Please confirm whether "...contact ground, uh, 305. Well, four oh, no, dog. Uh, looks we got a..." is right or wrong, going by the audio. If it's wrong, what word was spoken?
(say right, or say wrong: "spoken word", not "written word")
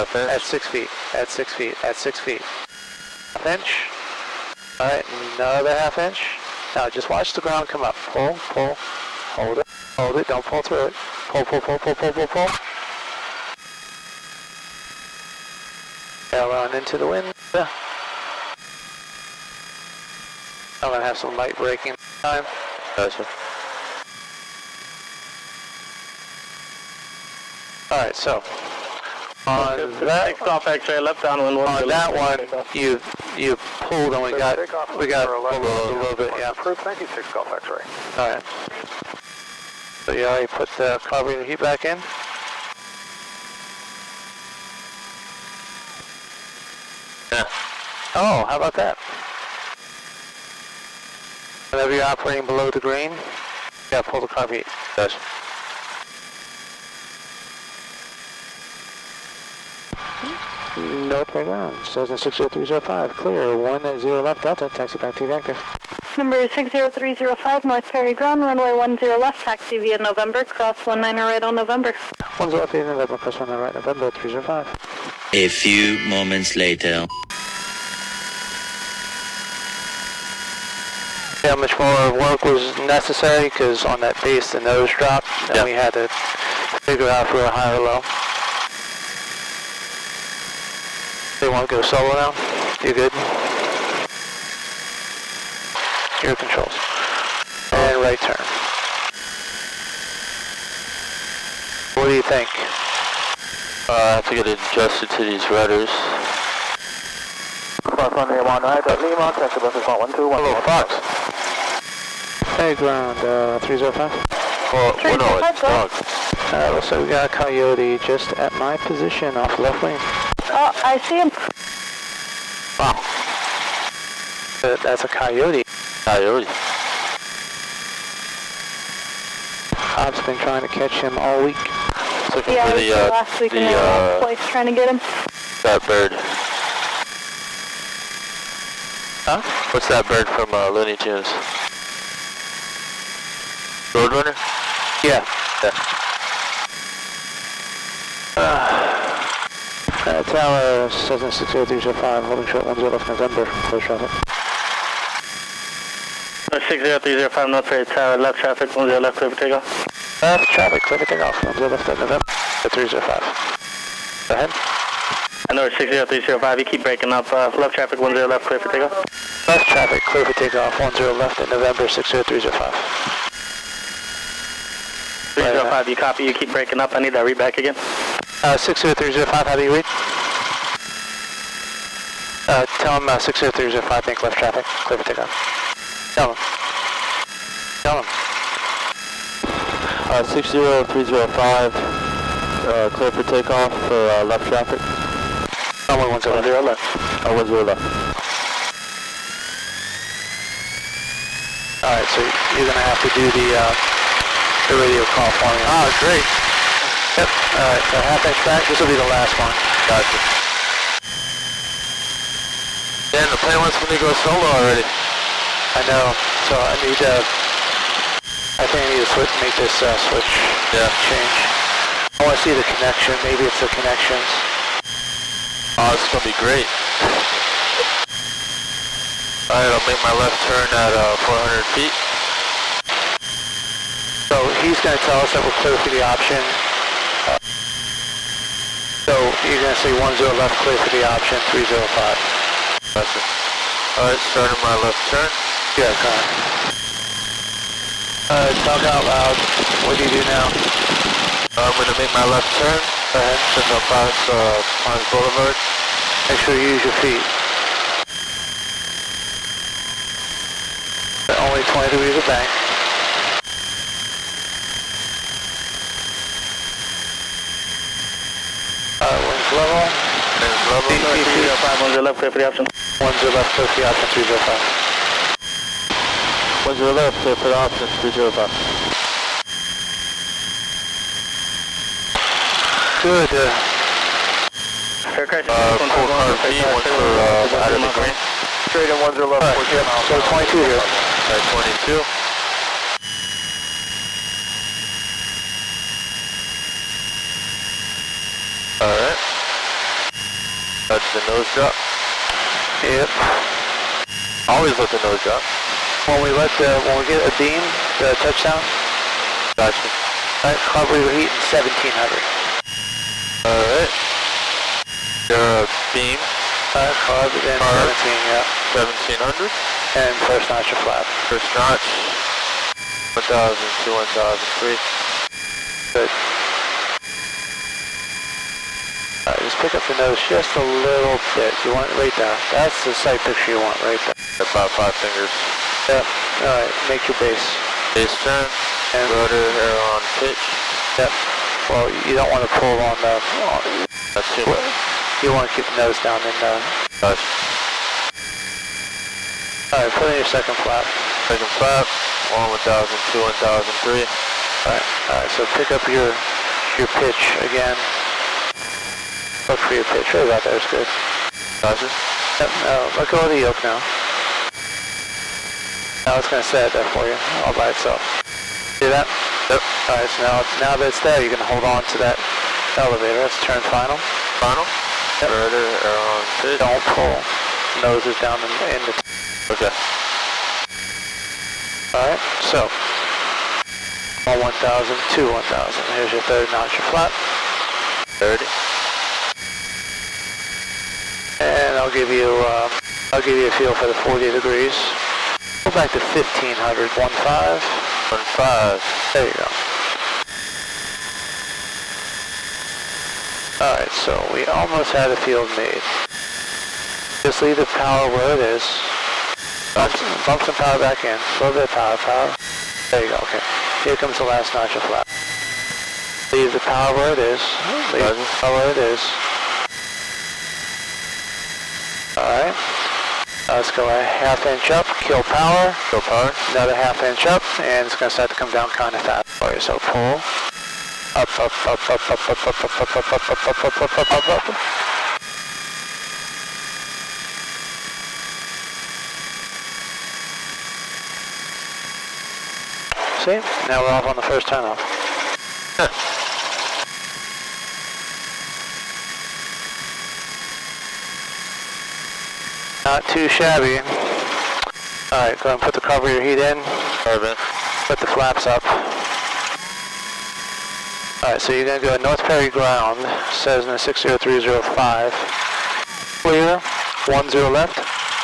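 wrong: "three", not "four".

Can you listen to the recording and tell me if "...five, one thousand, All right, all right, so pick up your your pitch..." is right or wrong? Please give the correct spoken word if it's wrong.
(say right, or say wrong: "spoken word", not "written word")
wrong: "two", not "five".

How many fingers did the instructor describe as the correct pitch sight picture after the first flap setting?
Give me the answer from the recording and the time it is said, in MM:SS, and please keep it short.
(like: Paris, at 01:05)
5, at 05:34.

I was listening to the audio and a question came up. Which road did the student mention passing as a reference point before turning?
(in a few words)
Pines Boulevard.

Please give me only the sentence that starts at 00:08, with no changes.
Pull, pull, hold it, hold it, don't pull through it.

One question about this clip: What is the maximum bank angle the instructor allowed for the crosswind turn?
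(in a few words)
20 degrees.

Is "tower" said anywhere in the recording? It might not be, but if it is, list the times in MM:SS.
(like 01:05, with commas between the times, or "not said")
02:30, 02:37.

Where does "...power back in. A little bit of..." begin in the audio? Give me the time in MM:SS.
06:50.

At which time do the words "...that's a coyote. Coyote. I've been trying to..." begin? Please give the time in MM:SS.
02:04.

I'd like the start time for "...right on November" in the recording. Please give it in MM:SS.
01:11.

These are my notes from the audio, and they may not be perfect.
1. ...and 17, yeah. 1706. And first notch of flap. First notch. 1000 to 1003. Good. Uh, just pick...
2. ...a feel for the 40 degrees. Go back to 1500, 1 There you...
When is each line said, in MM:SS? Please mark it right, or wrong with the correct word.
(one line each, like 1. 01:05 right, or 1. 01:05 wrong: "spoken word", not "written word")
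1. 05:17 wrong: "1700", not "1706"
2. 06:33 right.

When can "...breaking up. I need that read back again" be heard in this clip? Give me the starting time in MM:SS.
02:56.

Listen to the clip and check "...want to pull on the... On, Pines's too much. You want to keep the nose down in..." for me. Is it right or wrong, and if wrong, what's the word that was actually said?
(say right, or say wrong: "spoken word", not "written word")
wrong: "That", not "Pines".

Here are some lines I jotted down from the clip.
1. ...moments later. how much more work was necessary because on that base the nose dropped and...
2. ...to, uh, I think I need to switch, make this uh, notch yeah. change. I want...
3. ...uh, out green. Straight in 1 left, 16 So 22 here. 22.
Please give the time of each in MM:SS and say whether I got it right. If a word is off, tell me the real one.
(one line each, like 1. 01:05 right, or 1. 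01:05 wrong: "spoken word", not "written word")
1. 01:16 right
2. 03:36 wrong: "switch", not "notch"
3. 04:47 wrong: "14", not "16".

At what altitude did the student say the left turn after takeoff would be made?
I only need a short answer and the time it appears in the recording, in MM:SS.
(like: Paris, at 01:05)
400 feet, at 03:51.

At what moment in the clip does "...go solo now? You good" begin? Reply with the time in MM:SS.
01:31.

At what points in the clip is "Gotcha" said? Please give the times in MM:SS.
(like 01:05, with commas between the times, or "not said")
00:22, 03:29, 05:09.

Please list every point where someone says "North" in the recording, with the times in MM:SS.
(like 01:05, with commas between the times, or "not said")
01:07, 02:37, 07:42.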